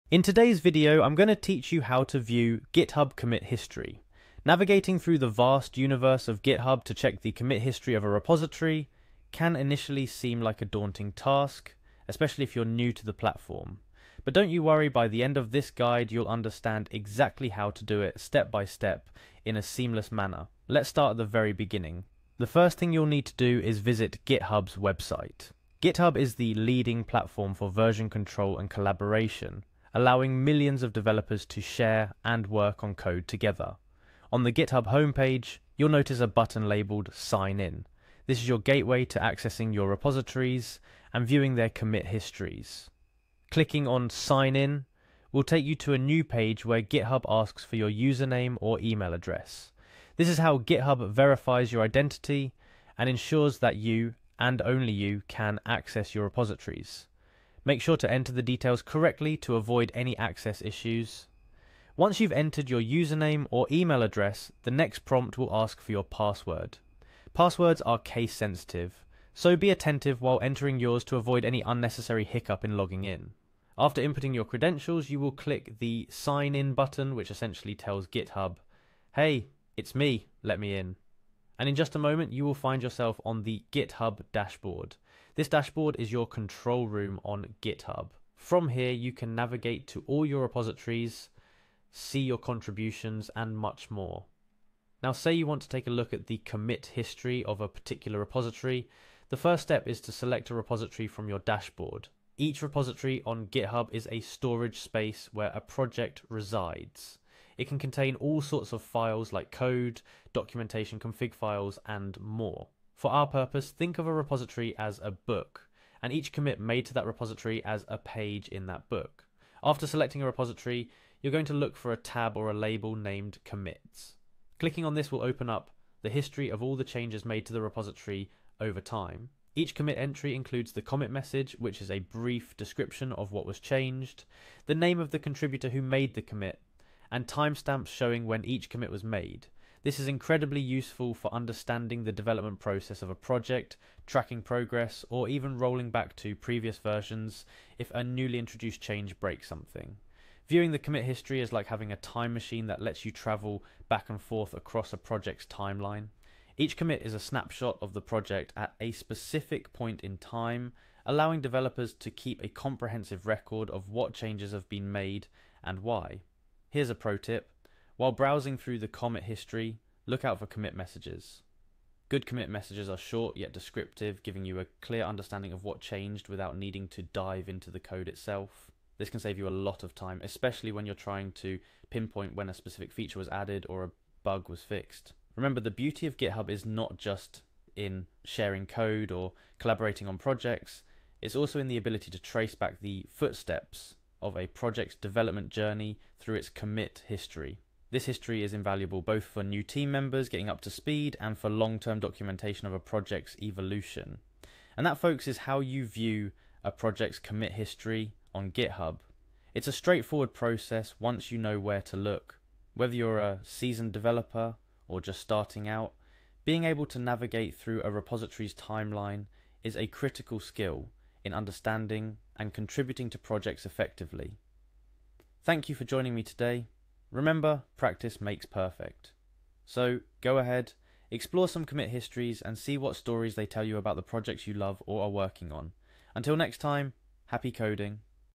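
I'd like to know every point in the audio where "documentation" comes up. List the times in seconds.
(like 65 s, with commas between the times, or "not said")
110 s, 201 s.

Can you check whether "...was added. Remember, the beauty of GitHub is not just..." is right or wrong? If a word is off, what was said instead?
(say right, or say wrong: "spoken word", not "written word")
wrong: "fixed", not "added".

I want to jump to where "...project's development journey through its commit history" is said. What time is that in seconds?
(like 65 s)
194 s.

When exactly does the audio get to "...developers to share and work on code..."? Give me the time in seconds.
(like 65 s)
30 s.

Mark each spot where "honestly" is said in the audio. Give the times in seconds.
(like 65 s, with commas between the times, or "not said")
not said.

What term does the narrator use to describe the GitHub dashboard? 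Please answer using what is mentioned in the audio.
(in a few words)
Control room.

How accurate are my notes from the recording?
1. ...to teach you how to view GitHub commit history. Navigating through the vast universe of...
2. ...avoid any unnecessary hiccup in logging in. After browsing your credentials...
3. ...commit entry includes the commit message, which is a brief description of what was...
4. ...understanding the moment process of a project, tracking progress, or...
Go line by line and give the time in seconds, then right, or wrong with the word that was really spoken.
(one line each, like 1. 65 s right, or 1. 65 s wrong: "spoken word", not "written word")
1. 1 s right
2. 71 s wrong: "inputting", not "browsing"
3. 129 s right
4. 141 s wrong: "development", not "moment".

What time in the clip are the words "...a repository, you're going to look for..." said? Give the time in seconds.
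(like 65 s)
120 s.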